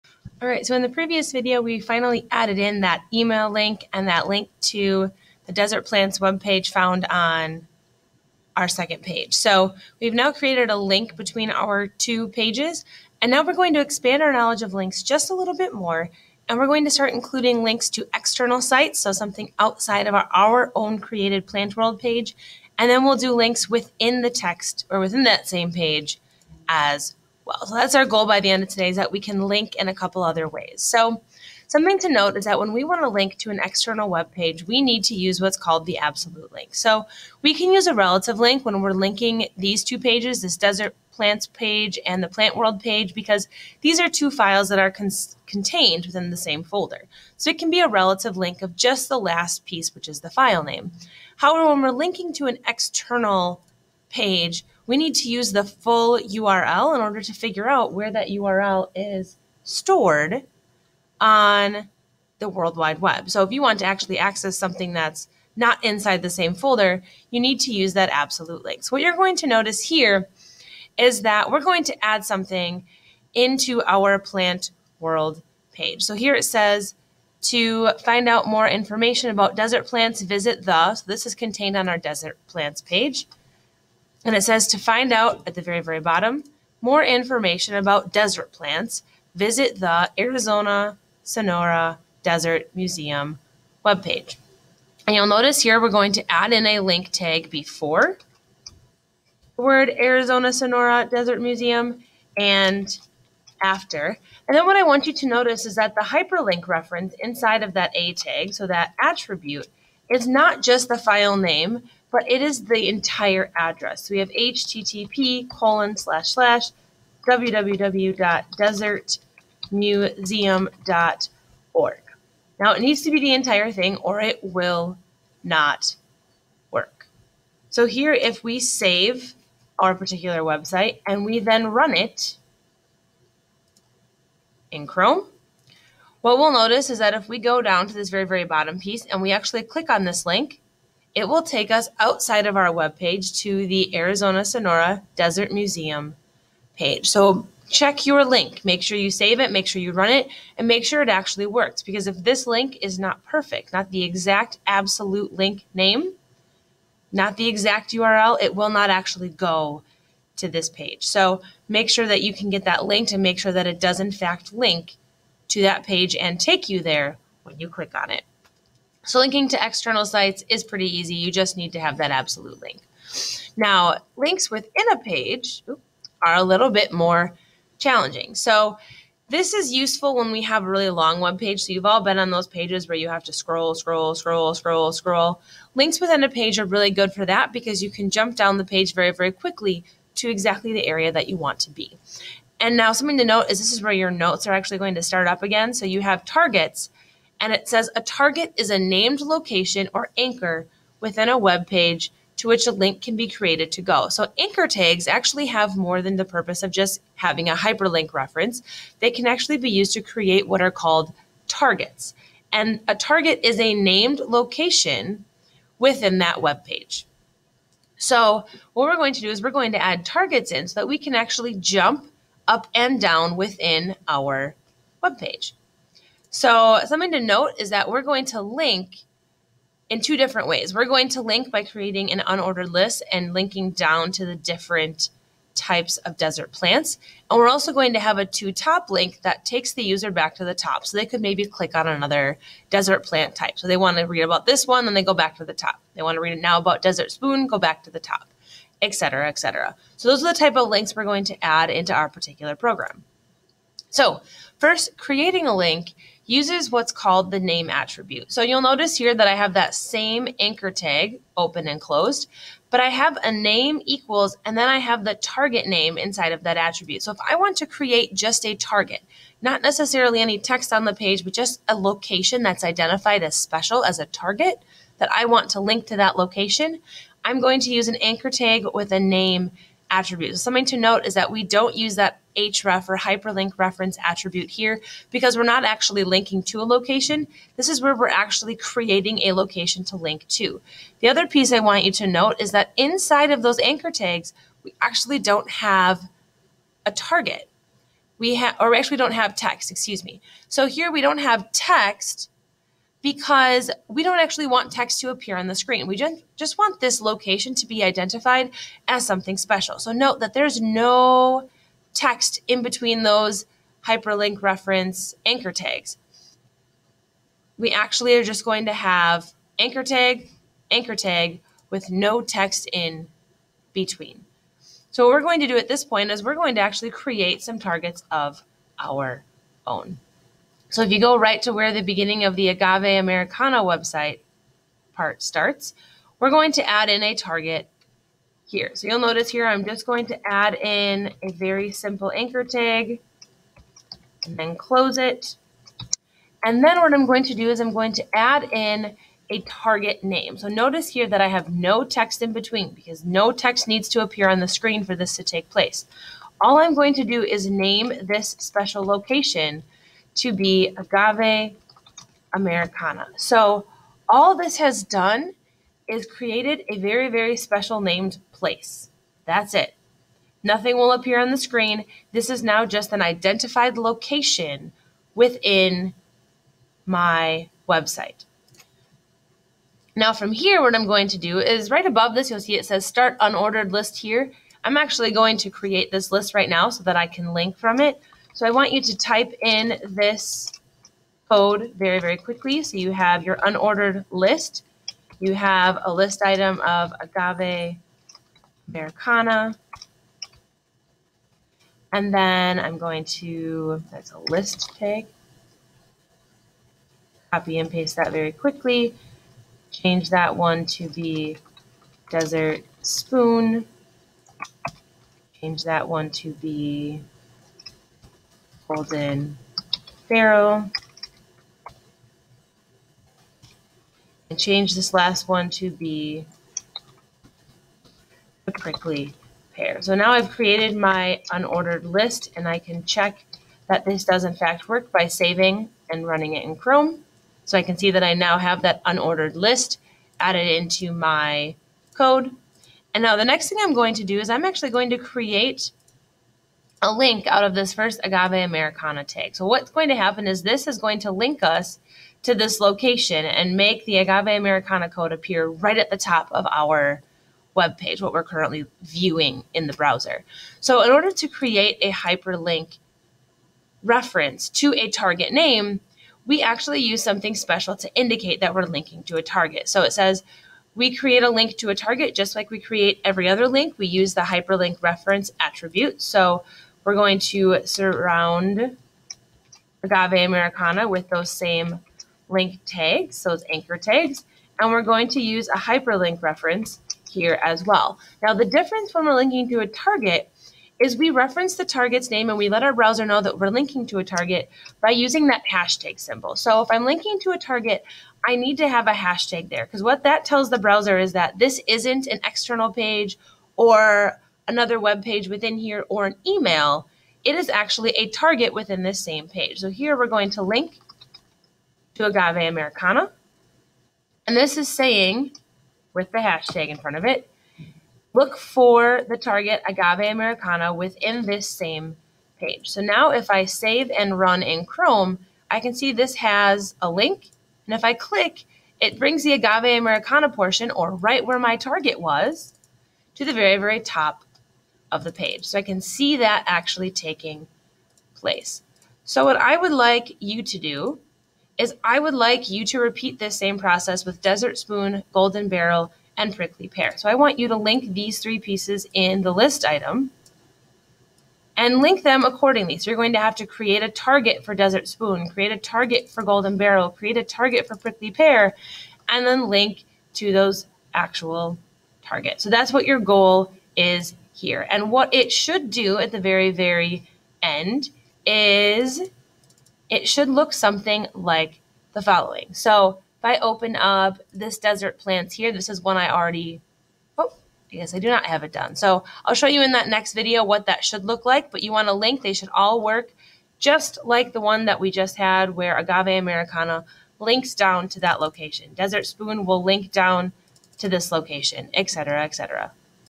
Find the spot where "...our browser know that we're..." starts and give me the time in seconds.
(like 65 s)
492 s.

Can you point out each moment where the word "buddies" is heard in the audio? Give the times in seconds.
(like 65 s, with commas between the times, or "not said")
not said.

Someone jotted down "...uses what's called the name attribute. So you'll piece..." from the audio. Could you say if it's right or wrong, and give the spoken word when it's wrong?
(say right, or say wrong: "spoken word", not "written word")
wrong: "notice", not "piece".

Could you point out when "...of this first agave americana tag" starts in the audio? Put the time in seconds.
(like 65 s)
447 s.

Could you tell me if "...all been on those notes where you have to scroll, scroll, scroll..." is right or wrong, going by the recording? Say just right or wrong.
wrong.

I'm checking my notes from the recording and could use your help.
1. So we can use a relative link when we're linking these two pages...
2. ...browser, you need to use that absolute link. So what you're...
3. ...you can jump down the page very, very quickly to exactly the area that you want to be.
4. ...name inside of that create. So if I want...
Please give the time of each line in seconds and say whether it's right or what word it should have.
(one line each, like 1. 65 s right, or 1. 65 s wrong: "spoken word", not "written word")
1. 36 s right
2. 66 s wrong: "folder", not "browser"
3. 187 s right
4. 265 s wrong: "attribute", not "create".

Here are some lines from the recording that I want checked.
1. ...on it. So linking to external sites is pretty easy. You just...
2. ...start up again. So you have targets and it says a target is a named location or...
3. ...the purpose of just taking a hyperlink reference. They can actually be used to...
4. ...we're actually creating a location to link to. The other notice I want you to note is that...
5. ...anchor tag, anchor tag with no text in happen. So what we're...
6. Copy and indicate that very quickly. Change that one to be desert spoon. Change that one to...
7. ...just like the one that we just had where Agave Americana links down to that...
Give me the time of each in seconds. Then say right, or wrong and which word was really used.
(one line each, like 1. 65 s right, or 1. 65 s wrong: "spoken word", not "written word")
1. 167 s right
2. 195 s right
3. 206 s wrong: "having", not "taking"
4. 287 s wrong: "piece", not "notice"
5. 319 s wrong: "between", not "happen"
6. 407 s wrong: "paste", not "indicate"
7. 583 s right.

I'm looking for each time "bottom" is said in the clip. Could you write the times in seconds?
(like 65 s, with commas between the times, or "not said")
85 s, 138 s.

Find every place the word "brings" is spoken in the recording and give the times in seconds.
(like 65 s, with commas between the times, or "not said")
528 s.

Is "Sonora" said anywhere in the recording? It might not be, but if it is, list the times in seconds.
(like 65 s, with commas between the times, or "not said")
91 s, 100 s, 144 s.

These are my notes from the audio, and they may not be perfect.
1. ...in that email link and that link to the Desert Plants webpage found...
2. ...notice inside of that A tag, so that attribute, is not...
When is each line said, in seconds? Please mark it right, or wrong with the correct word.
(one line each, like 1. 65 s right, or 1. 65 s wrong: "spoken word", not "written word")
1. 2 s right
2. 106 s wrong: "reference", not "notice".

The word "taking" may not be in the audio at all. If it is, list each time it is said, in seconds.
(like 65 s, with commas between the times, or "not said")
536 s.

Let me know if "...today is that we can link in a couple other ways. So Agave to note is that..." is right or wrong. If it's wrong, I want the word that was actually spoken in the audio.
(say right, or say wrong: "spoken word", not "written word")
wrong: "Something", not "Agave".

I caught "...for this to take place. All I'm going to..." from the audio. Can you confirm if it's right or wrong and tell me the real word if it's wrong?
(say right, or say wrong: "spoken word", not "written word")
right.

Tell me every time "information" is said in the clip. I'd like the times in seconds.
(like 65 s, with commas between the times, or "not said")
78 s, 87 s.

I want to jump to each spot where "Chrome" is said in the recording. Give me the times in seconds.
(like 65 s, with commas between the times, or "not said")
134 s, 436 s, 524 s.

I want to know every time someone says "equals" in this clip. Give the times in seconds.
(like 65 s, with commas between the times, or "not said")
263 s.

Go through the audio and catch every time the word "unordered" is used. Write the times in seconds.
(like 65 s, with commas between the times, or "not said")
232 s, 383 s, 393 s, 431 s, 438 s.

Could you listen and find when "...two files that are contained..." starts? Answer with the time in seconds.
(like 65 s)
44 s.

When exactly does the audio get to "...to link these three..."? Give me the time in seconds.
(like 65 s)
547 s.